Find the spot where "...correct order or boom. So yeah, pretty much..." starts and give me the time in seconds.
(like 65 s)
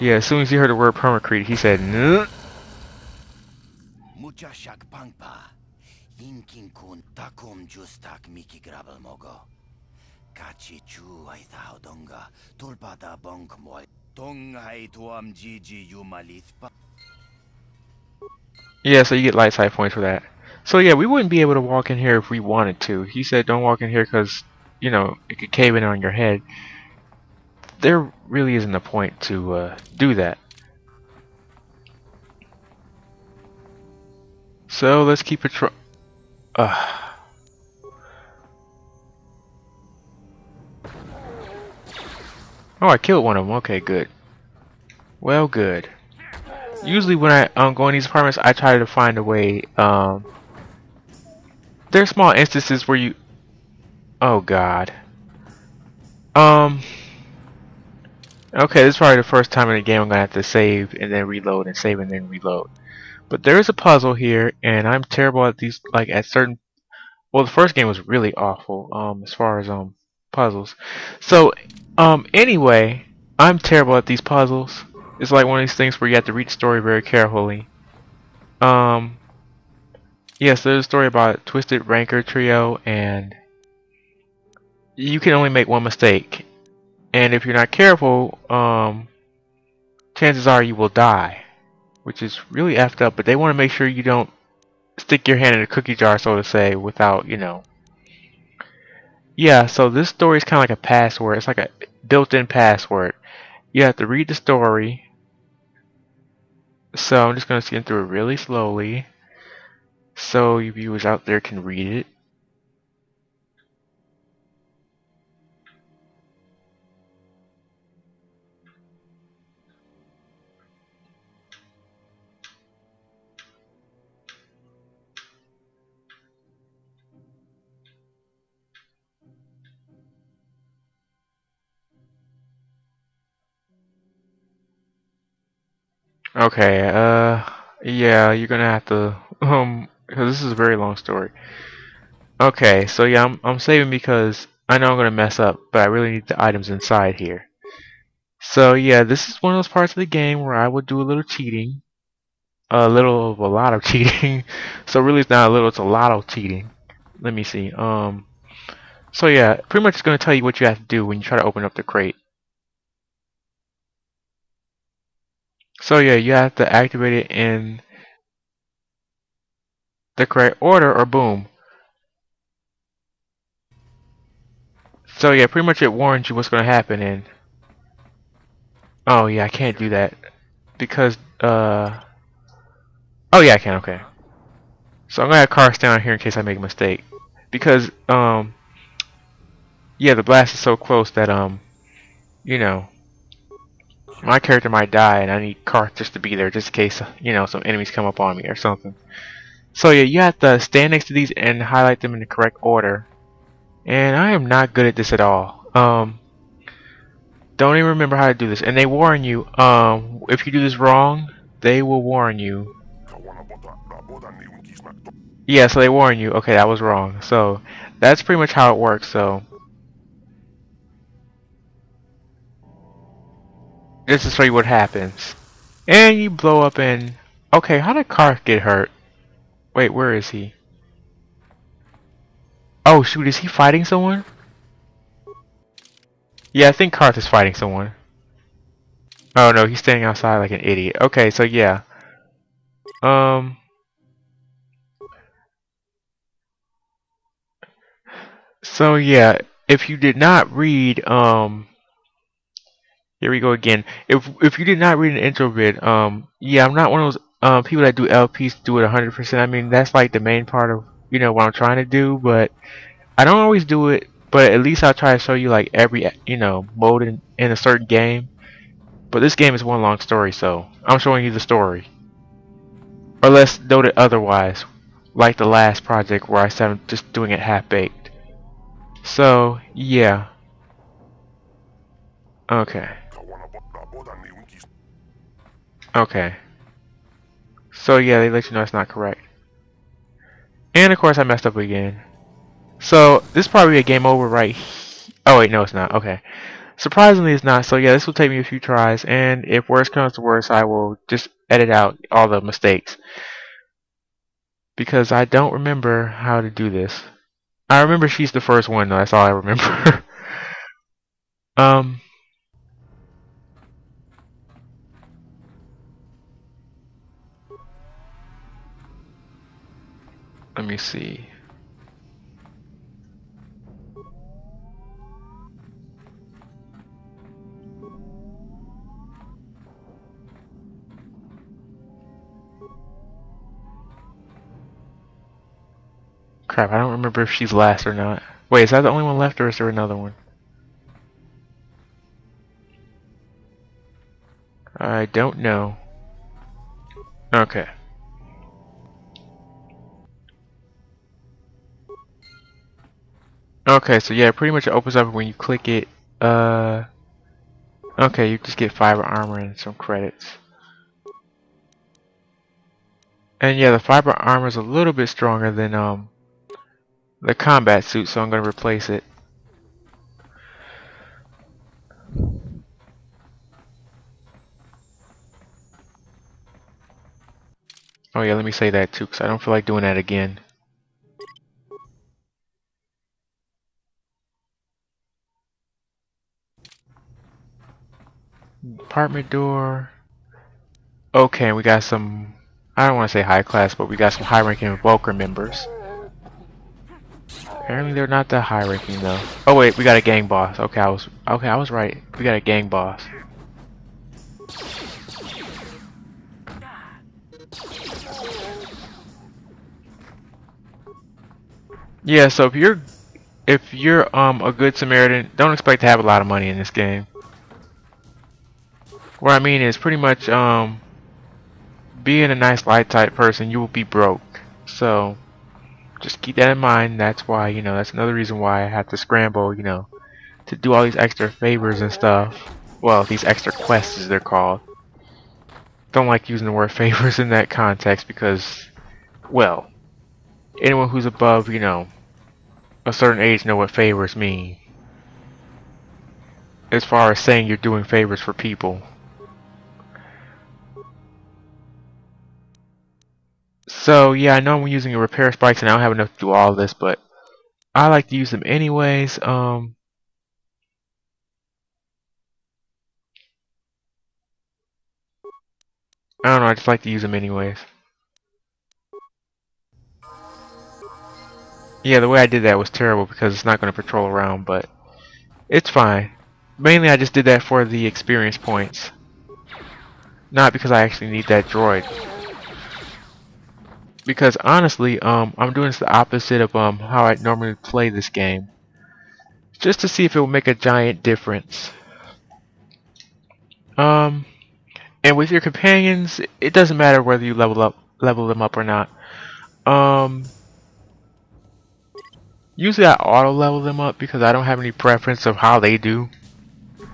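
170 s.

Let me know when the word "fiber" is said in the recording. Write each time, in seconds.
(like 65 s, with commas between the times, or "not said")
358 s, 363 s.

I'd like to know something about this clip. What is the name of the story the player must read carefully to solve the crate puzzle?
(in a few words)
Twisted Ranker Trio.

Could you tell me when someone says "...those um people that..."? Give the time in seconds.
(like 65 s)
257 s.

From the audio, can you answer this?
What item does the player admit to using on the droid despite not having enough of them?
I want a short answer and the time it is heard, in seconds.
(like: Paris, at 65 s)
repair spikes, at 454 s.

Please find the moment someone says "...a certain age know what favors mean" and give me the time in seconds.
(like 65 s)
442 s.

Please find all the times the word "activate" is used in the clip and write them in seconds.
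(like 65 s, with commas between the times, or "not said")
166 s.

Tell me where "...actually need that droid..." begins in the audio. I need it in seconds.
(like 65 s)
480 s.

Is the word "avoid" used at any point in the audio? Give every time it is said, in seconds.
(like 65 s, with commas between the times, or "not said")
not said.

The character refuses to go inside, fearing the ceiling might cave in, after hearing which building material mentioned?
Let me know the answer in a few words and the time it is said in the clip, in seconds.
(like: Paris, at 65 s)
permacrete, at 0 s.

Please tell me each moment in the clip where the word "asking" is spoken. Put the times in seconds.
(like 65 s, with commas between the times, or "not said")
not said.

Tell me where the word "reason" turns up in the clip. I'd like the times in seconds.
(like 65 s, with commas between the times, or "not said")
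428 s.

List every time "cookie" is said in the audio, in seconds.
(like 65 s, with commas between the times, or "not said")
95 s.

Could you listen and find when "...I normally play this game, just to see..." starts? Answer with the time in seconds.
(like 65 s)
487 s.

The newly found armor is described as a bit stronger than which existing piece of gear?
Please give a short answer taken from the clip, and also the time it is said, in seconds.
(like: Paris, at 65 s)
combat suit, at 367 s.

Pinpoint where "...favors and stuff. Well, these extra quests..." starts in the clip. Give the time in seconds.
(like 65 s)
431 s.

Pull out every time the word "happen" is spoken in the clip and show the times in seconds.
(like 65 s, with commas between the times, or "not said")
176 s, 224 s.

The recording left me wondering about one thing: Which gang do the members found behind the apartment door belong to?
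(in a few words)
Vulkar.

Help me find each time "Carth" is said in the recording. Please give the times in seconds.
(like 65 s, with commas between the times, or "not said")
185 s, 195 s, 228 s, 236 s.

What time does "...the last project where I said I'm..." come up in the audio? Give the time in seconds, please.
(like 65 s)
275 s.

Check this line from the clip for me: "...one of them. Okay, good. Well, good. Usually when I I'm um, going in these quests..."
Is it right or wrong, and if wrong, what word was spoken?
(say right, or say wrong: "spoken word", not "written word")
wrong: "apartments", not "quests".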